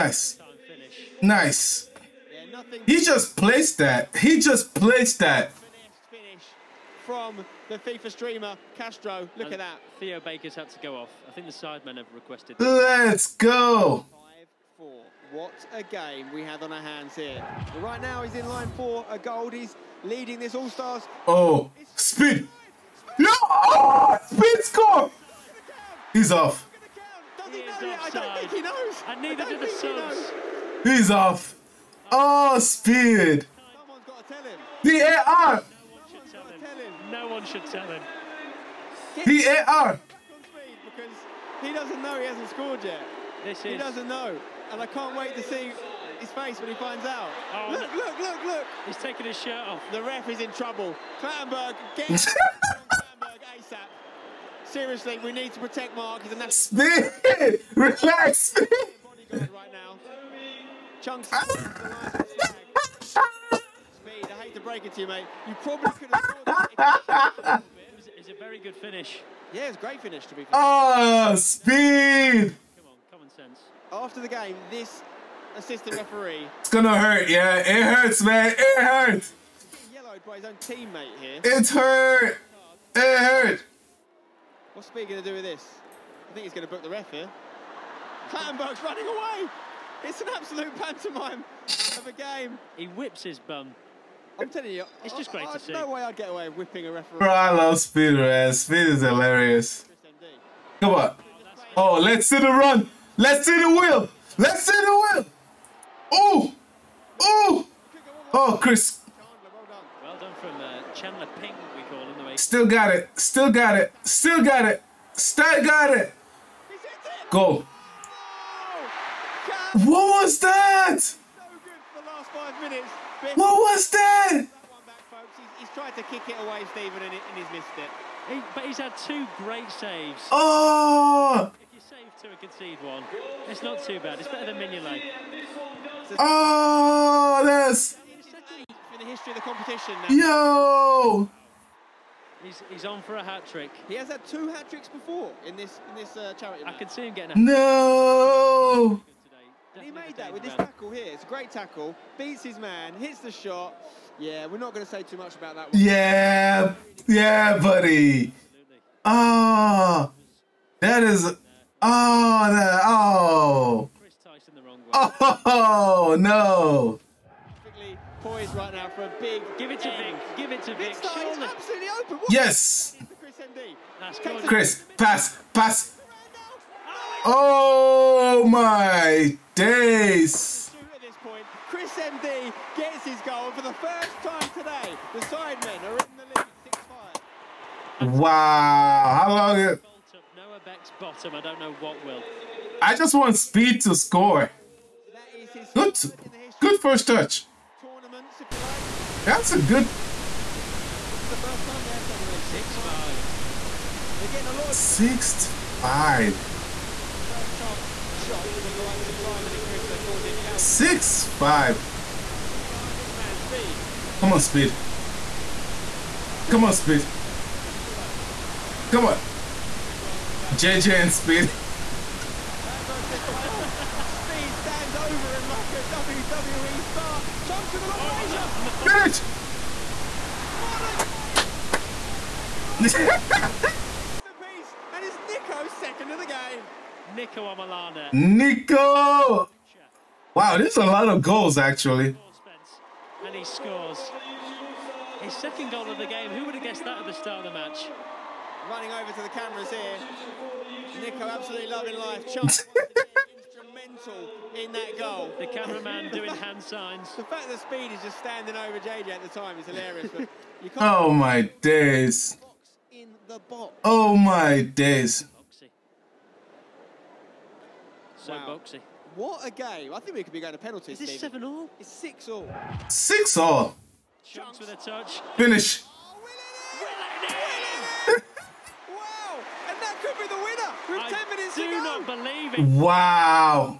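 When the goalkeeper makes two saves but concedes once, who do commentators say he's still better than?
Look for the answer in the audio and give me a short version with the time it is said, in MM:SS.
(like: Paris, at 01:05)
Mignolet, at 02:14.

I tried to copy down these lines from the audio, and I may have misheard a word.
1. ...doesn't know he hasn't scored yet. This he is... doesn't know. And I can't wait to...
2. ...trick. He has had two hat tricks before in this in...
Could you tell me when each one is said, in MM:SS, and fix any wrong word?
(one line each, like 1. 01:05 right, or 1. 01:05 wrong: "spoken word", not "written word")
1. 00:41 right
2. 02:23 right.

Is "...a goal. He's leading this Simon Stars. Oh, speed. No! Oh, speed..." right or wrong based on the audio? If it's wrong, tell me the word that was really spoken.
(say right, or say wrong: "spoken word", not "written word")
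wrong: "All", not "Simon".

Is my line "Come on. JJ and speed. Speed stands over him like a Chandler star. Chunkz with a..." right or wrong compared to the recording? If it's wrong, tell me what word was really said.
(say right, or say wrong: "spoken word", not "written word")
wrong: "WWE", not "Chandler".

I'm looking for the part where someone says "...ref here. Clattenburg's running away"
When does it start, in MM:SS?
01:26.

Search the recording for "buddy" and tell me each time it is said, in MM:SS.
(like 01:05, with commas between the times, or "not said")
02:37.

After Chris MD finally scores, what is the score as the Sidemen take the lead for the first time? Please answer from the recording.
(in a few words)
6-5.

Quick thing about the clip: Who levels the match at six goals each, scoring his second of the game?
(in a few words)
Niko Omilana.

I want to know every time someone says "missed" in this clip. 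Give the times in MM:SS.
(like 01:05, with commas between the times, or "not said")
02:07.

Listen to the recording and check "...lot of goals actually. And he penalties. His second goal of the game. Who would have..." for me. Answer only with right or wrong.
wrong.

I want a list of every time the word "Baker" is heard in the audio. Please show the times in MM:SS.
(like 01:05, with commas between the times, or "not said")
00:10.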